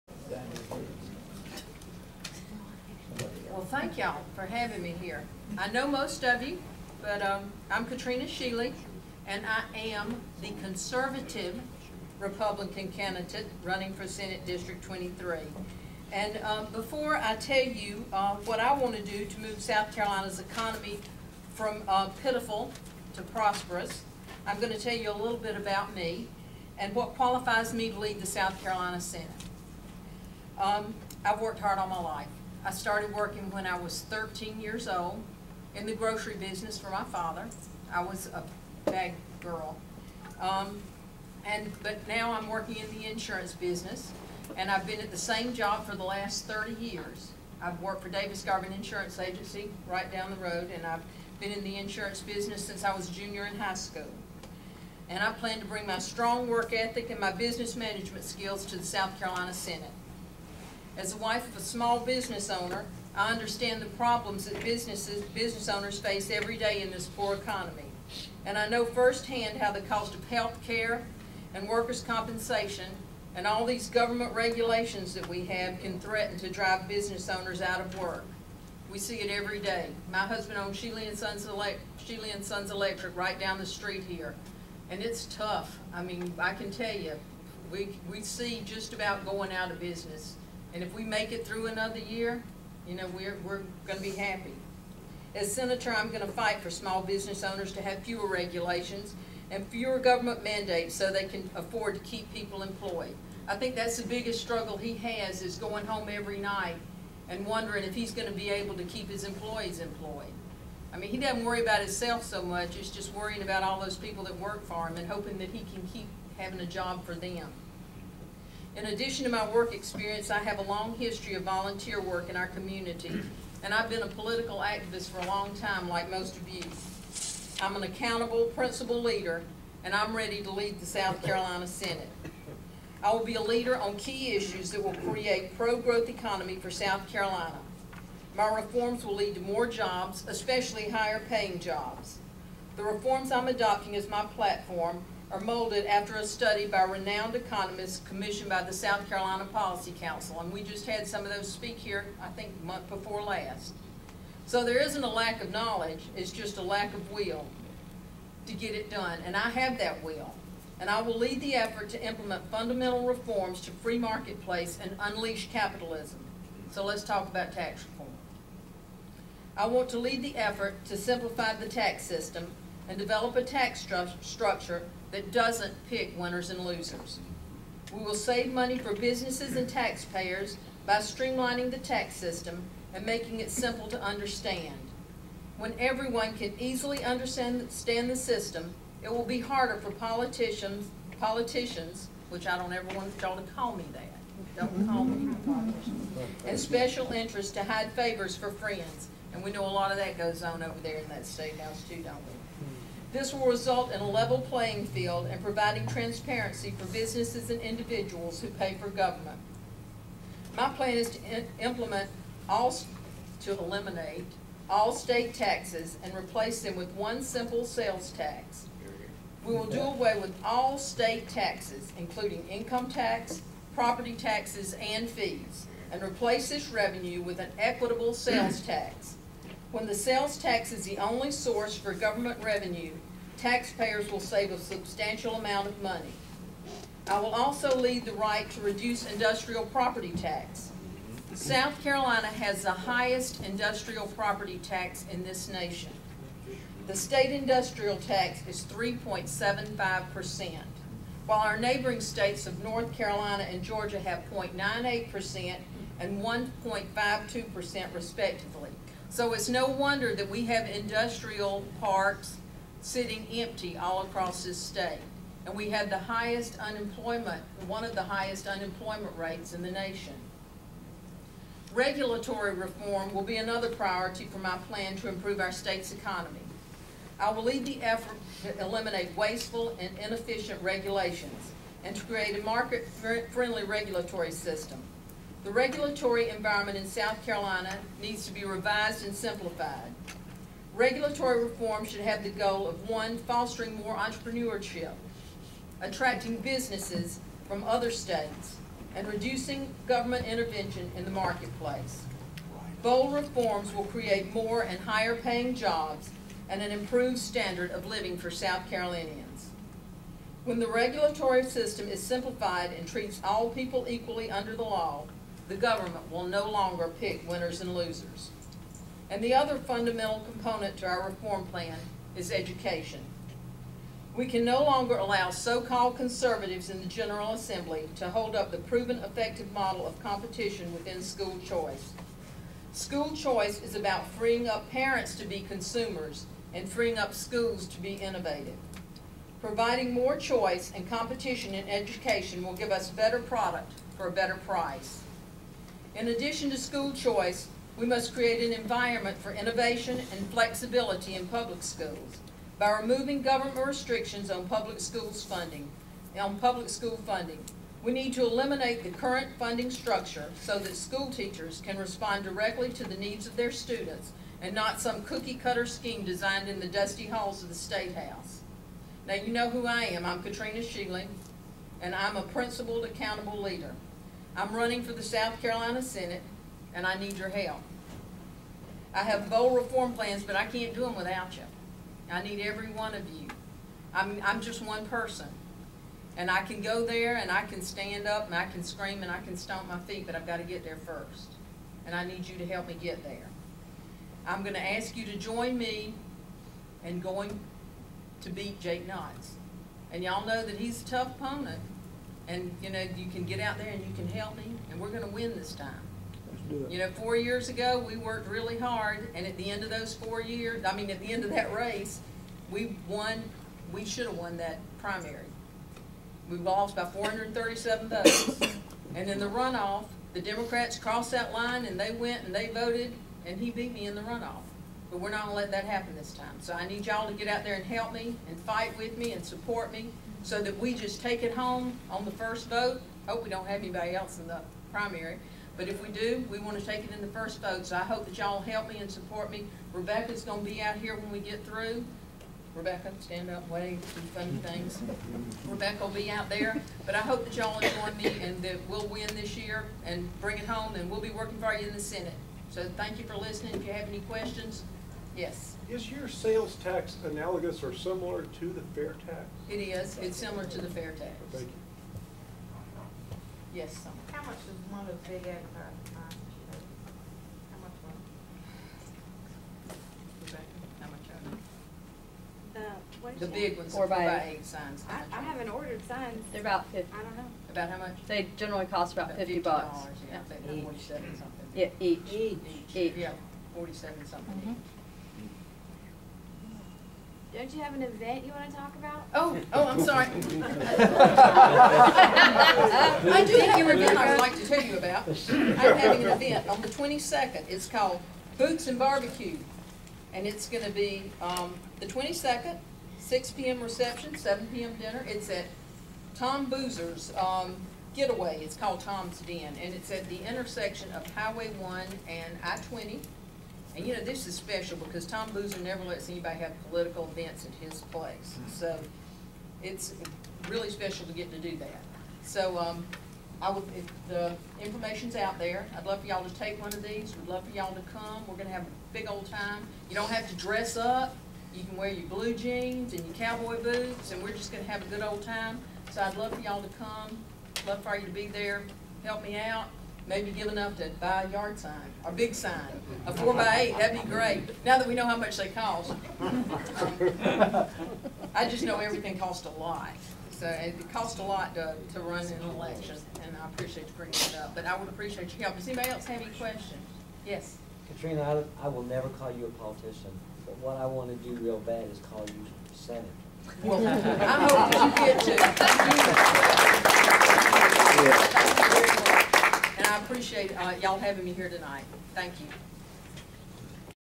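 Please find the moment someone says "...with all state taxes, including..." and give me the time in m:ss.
3:40.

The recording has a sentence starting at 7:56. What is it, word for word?
They're about fifty, I don't know.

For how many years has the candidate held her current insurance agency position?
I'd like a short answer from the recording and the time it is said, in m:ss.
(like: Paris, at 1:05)
30 years, at 0:46.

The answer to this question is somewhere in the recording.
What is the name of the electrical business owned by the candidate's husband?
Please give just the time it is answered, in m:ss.
1:22.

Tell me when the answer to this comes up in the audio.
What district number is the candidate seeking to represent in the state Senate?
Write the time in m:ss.
0:14.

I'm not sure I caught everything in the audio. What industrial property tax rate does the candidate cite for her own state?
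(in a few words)
3.75%.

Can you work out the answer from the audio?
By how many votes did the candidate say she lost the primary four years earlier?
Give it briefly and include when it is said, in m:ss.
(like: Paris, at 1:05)
437, at 6:56.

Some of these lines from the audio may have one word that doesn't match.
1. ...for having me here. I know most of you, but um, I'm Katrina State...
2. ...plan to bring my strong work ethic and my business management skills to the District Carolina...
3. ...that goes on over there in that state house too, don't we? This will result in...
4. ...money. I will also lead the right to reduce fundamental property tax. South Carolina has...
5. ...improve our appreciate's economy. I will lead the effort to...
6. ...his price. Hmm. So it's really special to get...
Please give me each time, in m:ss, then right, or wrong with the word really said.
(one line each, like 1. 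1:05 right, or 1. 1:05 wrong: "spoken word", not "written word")
1. 0:04 wrong: "Shealy", not "State"
2. 0:55 wrong: "South", not "District"
3. 3:19 right
4. 3:55 wrong: "industrial", not "fundamental"
5. 4:35 wrong: "state", not "appreciate"
6. 8:37 wrong: "place", not "price".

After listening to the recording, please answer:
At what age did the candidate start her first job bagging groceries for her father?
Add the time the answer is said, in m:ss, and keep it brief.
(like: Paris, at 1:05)
13, at 0:34.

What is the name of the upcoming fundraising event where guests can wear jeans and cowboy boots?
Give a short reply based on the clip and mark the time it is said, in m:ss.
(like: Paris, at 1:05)
Boots and Barbecue, at 8:18.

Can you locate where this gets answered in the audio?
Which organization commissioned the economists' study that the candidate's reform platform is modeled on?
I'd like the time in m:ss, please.
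2:28.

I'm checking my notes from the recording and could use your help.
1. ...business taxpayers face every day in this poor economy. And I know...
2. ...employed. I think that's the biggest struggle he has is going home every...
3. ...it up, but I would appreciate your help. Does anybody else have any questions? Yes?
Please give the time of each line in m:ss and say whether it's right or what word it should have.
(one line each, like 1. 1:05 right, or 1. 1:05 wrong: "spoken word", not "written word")
1. 1:05 wrong: "owners", not "taxpayers"
2. 1:42 right
3. 9:14 right.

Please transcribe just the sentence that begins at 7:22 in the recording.
Rebecca, stand up, wave, do funny things.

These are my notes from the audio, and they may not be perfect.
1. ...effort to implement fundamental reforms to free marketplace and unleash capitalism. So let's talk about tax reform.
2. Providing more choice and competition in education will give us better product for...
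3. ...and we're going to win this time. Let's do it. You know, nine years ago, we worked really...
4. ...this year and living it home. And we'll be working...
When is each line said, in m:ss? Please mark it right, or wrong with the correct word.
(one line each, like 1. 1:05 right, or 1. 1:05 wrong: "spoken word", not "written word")
1. 2:41 right
2. 5:39 right
3. 6:44 wrong: "four", not "nine"
4. 7:29 wrong: "bring", not "living".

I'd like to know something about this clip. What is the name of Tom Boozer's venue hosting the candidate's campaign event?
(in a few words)
Tom's Den.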